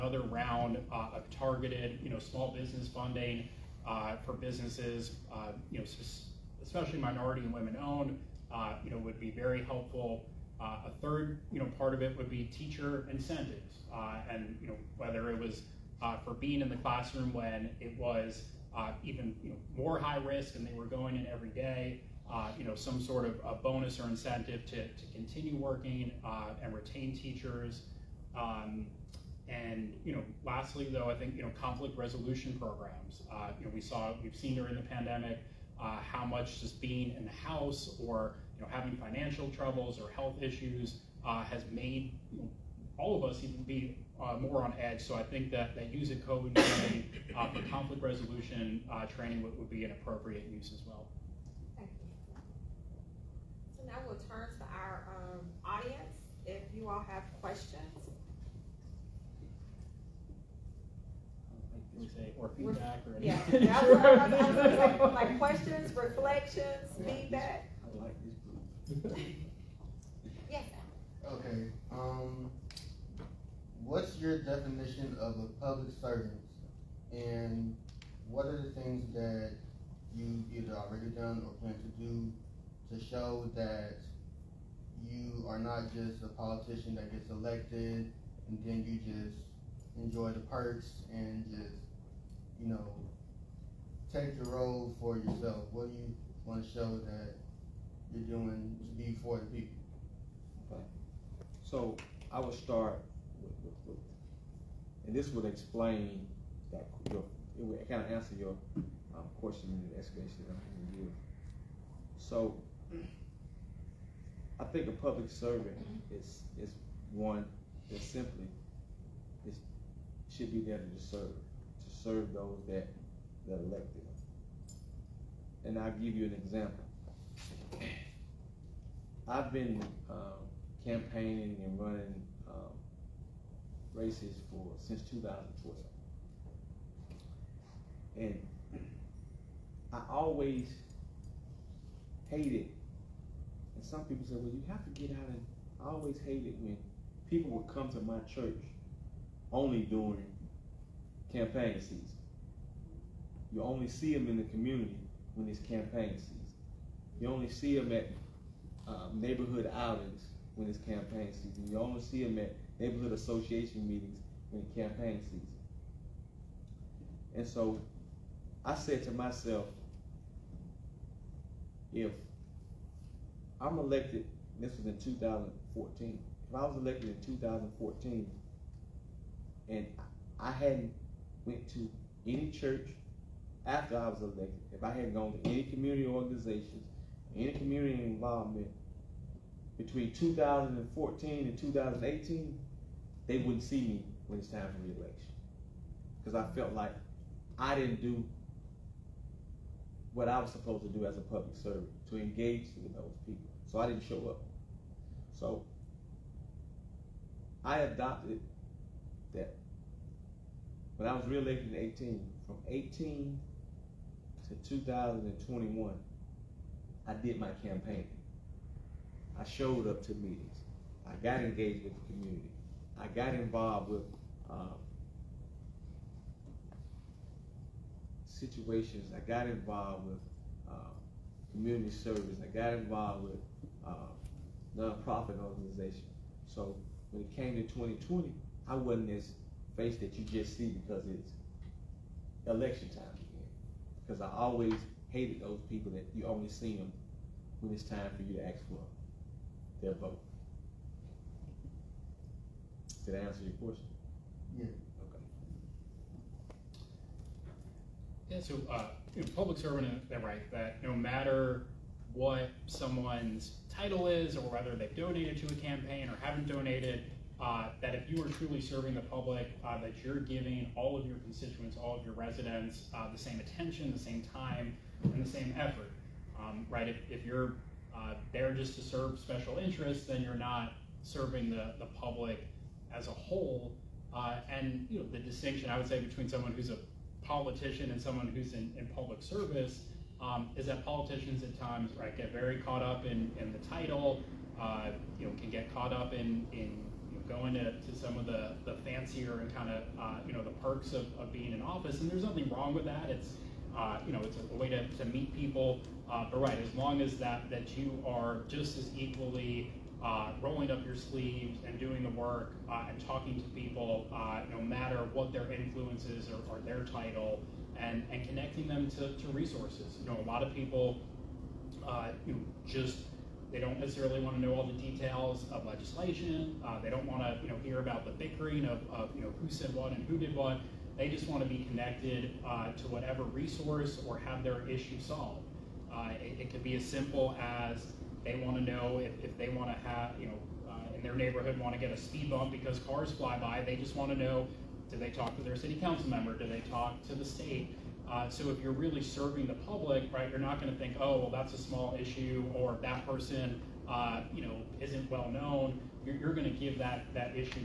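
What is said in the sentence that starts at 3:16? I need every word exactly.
Because I felt like I didn't do what I was supposed to do as a public servant to engage with those people.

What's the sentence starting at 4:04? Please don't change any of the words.
Because I always hated those people that you only see them when it's time for you to ask for their vote.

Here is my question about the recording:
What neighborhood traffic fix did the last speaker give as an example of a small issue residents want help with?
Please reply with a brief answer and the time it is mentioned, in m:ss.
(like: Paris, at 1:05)
A speed bump, at 5:41.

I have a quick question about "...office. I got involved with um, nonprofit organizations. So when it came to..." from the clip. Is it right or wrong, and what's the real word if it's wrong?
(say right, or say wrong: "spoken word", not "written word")
wrong: "service", not "office".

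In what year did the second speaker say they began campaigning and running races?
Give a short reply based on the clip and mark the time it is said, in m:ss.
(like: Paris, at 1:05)
2012, at 2:15.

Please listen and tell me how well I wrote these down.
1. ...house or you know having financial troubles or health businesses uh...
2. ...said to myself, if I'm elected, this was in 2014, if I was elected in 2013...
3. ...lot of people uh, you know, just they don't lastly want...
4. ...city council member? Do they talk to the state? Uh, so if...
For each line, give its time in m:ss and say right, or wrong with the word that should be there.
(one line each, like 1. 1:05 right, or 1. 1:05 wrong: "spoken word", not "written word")
1. 0:37 wrong: "issues", not "businesses"
2. 2:48 wrong: "2014", not "2013"
3. 5:20 wrong: "necessarily", not "lastly"
4. 5:45 right.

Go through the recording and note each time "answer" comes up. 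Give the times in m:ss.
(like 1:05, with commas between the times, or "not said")
1:48, 4:13.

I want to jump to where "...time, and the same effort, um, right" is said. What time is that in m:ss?
4:34.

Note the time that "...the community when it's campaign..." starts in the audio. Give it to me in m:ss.
2:34.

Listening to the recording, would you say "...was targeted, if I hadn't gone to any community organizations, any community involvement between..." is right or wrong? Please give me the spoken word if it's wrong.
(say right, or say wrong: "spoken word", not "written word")
wrong: "elected", not "targeted".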